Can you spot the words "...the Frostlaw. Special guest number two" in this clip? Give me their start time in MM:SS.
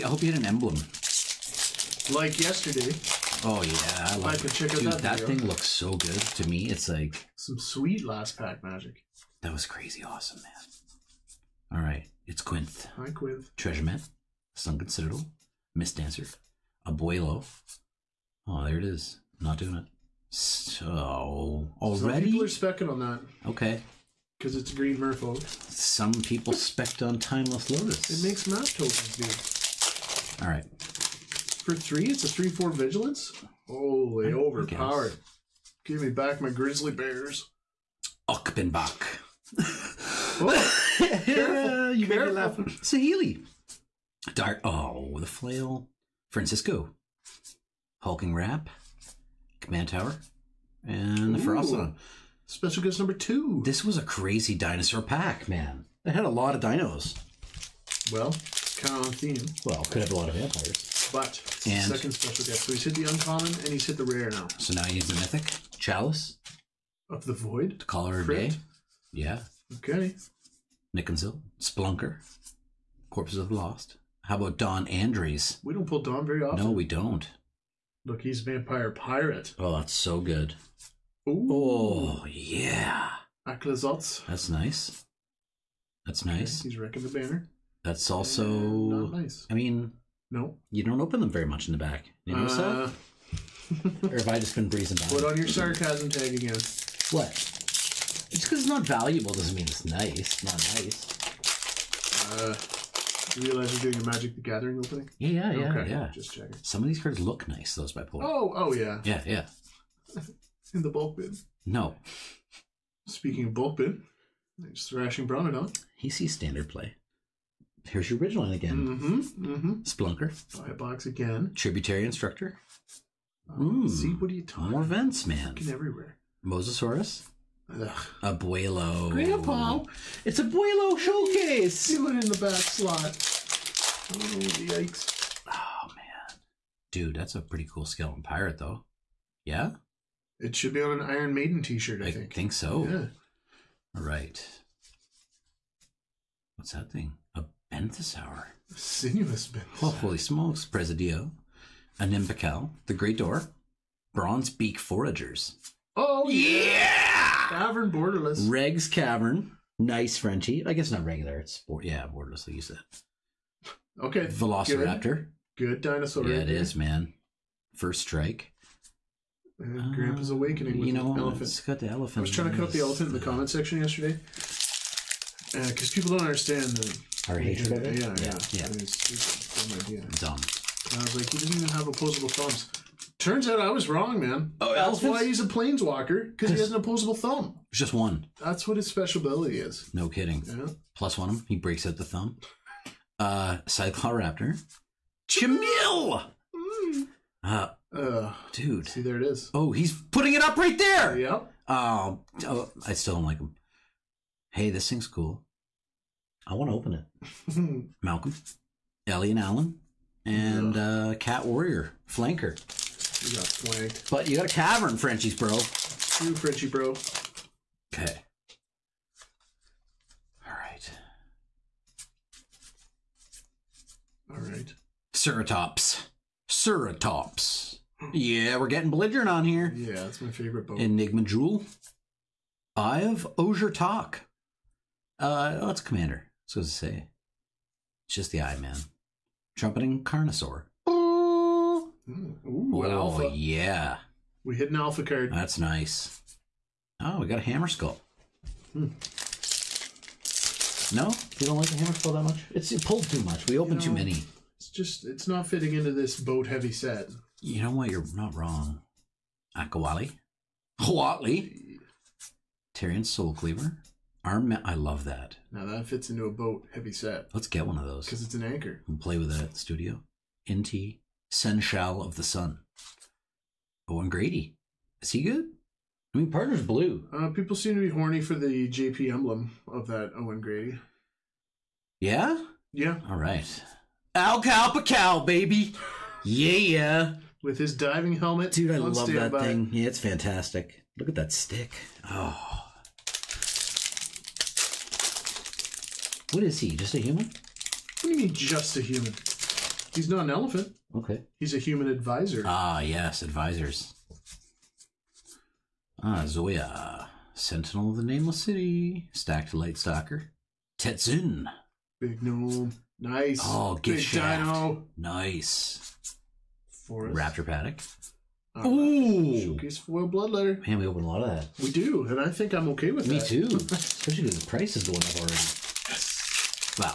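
00:51.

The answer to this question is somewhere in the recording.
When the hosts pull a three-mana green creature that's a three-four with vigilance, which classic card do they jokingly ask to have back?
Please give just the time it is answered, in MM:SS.
00:36.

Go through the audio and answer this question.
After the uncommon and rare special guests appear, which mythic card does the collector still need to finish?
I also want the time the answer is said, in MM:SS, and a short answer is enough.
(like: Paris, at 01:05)
Chalice of the Void, at 01:05.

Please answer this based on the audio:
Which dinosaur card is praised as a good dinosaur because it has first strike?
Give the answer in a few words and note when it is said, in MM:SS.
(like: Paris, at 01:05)
Velociraptor, at 02:44.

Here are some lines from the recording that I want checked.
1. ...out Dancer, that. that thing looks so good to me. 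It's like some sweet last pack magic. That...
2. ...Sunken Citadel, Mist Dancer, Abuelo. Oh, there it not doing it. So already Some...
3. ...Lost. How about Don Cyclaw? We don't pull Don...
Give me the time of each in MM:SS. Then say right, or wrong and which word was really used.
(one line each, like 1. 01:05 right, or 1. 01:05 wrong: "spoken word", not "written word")
1. 00:04 wrong: "Dude", not "Dancer"
2. 00:14 right
3. 01:13 wrong: "Andres", not "Cyclaw".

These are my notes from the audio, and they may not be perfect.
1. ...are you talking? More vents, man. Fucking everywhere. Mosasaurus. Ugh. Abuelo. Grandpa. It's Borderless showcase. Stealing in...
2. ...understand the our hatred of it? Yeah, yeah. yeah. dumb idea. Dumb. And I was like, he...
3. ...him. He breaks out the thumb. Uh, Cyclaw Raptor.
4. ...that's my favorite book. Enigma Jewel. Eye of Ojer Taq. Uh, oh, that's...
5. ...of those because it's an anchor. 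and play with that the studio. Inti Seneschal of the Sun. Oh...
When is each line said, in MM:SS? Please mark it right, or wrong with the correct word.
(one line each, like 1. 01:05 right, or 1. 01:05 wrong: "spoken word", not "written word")
1. 02:04 wrong: "Abuelo", not "Borderless"
2. 02:56 right
3. 03:11 right
4. 03:49 right
5. 04:27 right.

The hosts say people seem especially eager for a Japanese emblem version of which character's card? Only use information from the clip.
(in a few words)
Owen Grady.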